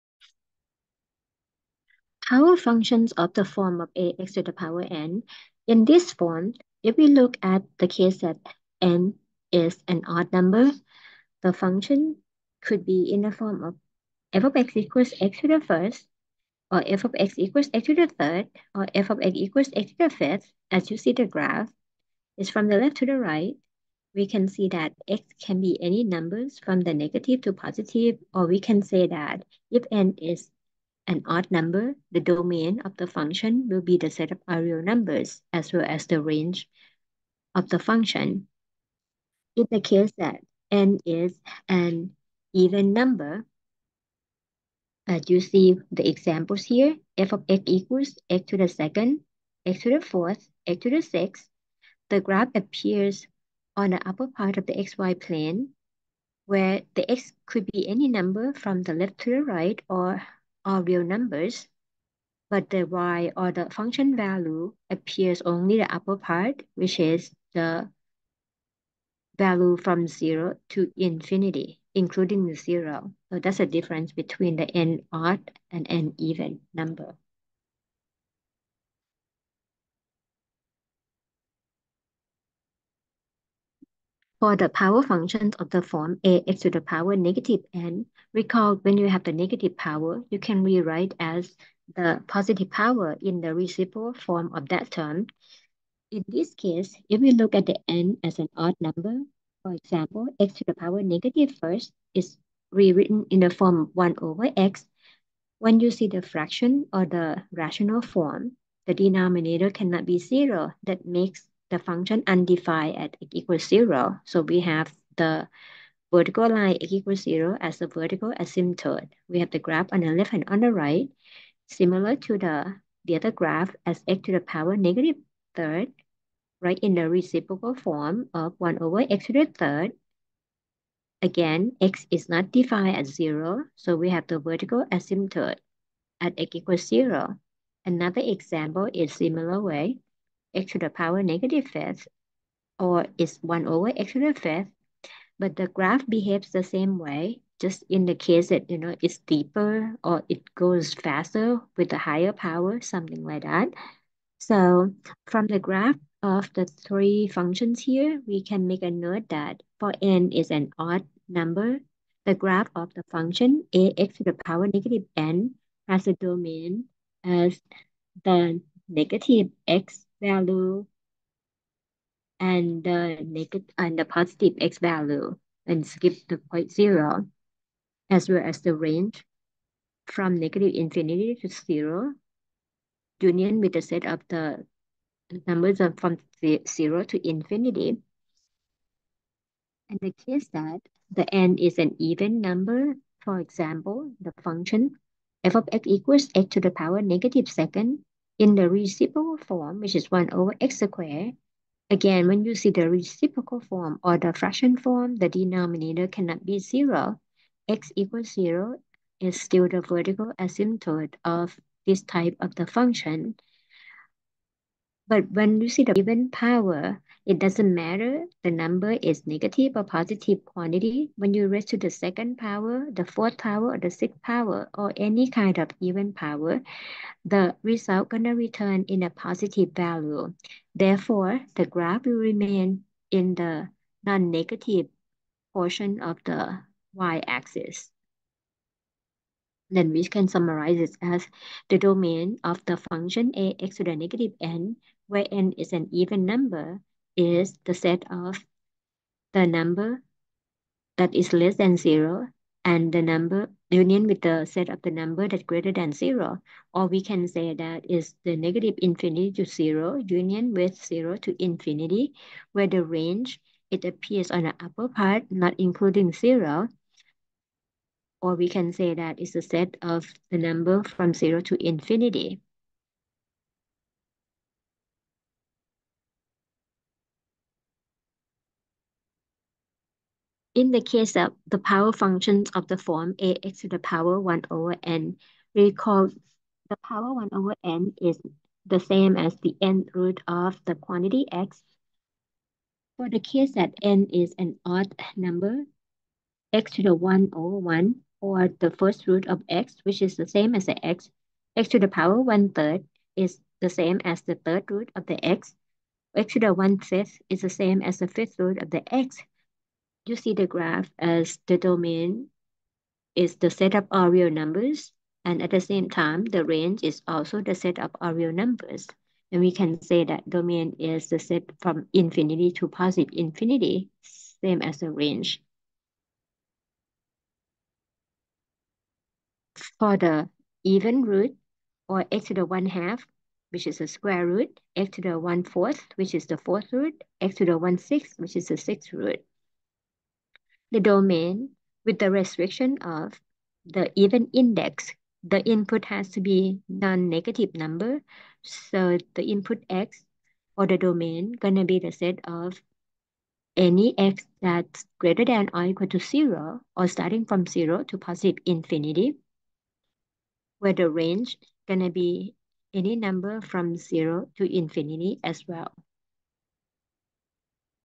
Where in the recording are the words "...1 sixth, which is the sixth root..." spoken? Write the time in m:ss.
5:37.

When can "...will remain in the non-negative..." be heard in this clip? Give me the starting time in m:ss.
3:52.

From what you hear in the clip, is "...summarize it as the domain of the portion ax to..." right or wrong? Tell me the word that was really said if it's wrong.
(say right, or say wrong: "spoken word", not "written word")
wrong: "function", not "portion".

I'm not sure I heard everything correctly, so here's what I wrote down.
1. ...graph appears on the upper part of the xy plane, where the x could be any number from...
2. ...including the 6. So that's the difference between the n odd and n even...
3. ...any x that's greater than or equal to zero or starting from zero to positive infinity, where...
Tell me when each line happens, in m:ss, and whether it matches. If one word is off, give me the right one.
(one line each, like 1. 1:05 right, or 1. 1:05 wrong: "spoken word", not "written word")
1. 0:52 right
2. 1:11 wrong: "0", not "6"
3. 5:53 right.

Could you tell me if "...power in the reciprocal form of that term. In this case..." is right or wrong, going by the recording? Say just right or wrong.
right.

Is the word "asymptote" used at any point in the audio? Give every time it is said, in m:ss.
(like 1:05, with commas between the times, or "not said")
1:58, 2:14, 3:30.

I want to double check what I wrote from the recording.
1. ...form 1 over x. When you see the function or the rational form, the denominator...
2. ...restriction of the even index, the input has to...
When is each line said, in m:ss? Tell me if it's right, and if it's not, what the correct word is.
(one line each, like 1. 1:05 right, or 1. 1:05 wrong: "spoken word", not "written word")
1. 1:43 wrong: "fraction", not "function"
2. 5:42 right.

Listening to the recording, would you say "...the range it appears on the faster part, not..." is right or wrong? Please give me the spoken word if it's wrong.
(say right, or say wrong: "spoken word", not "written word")
wrong: "upper", not "faster".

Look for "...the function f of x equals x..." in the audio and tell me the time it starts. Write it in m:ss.
3:14.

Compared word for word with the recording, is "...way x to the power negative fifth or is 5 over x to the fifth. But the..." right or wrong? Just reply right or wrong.
wrong.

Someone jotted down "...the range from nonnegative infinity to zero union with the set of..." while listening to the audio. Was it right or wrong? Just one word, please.
wrong.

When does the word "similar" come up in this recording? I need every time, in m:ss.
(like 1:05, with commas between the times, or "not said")
2:01, 2:19.